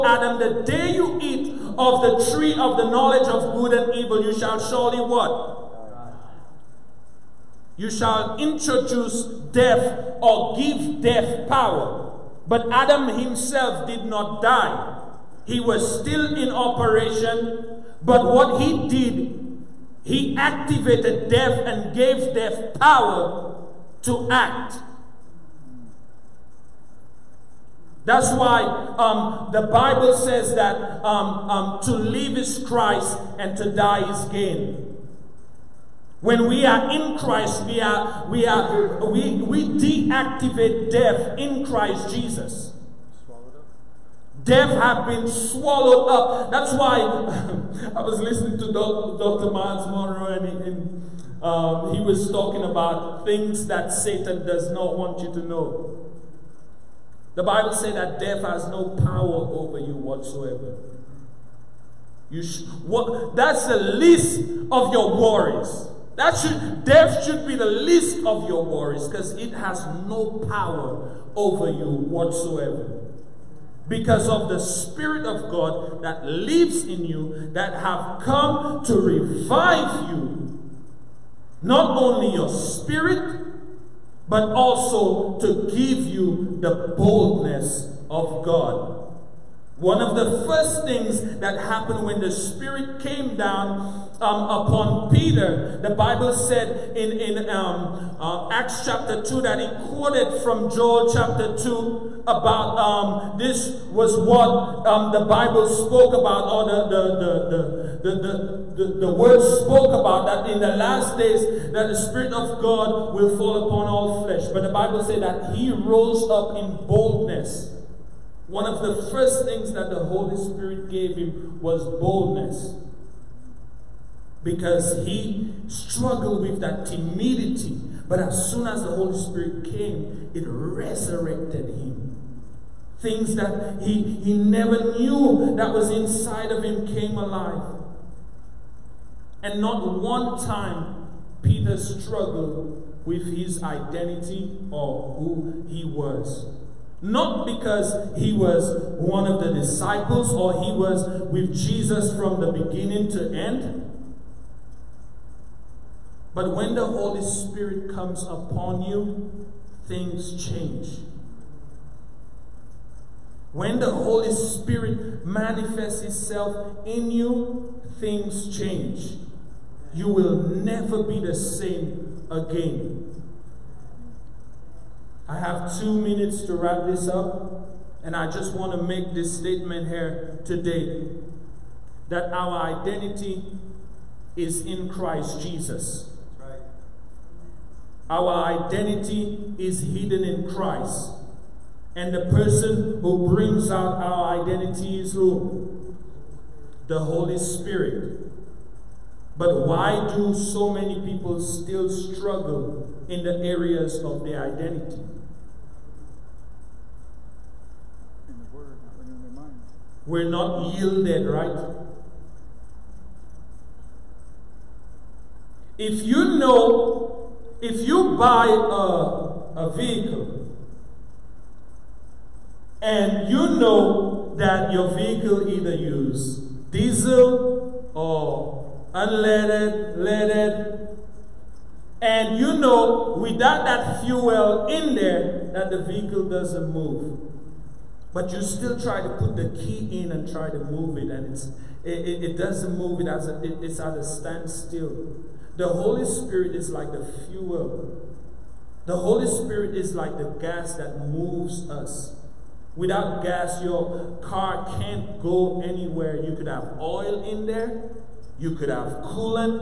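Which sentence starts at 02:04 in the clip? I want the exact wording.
Because he struggled with that timidity.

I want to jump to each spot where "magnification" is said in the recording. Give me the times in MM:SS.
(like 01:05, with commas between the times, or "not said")
not said.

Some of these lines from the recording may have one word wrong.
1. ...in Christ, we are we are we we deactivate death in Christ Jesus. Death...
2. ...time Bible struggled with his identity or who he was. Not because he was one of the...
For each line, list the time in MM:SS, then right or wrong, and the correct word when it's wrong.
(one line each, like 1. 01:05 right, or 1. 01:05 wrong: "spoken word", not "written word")
1. 00:36 right
2. 02:20 wrong: "Peter", not "Bible".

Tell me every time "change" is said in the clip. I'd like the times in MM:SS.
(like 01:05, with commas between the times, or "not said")
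02:40, 02:48.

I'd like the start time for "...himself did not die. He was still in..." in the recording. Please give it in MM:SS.
00:13.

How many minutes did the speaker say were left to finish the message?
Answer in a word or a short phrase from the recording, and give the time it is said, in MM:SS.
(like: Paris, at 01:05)
2, at 02:55.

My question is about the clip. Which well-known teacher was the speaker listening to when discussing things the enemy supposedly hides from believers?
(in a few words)
Dr. Myles Munroe.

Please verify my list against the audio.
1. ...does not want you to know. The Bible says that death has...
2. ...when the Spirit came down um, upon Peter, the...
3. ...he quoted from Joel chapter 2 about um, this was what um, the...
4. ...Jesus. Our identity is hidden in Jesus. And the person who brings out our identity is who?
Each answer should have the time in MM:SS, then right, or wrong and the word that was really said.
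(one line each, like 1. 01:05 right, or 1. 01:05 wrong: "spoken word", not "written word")
1. 00:54 right
2. 01:32 right
3. 01:39 right
4. 03:05 wrong: "Christ", not "Jesus".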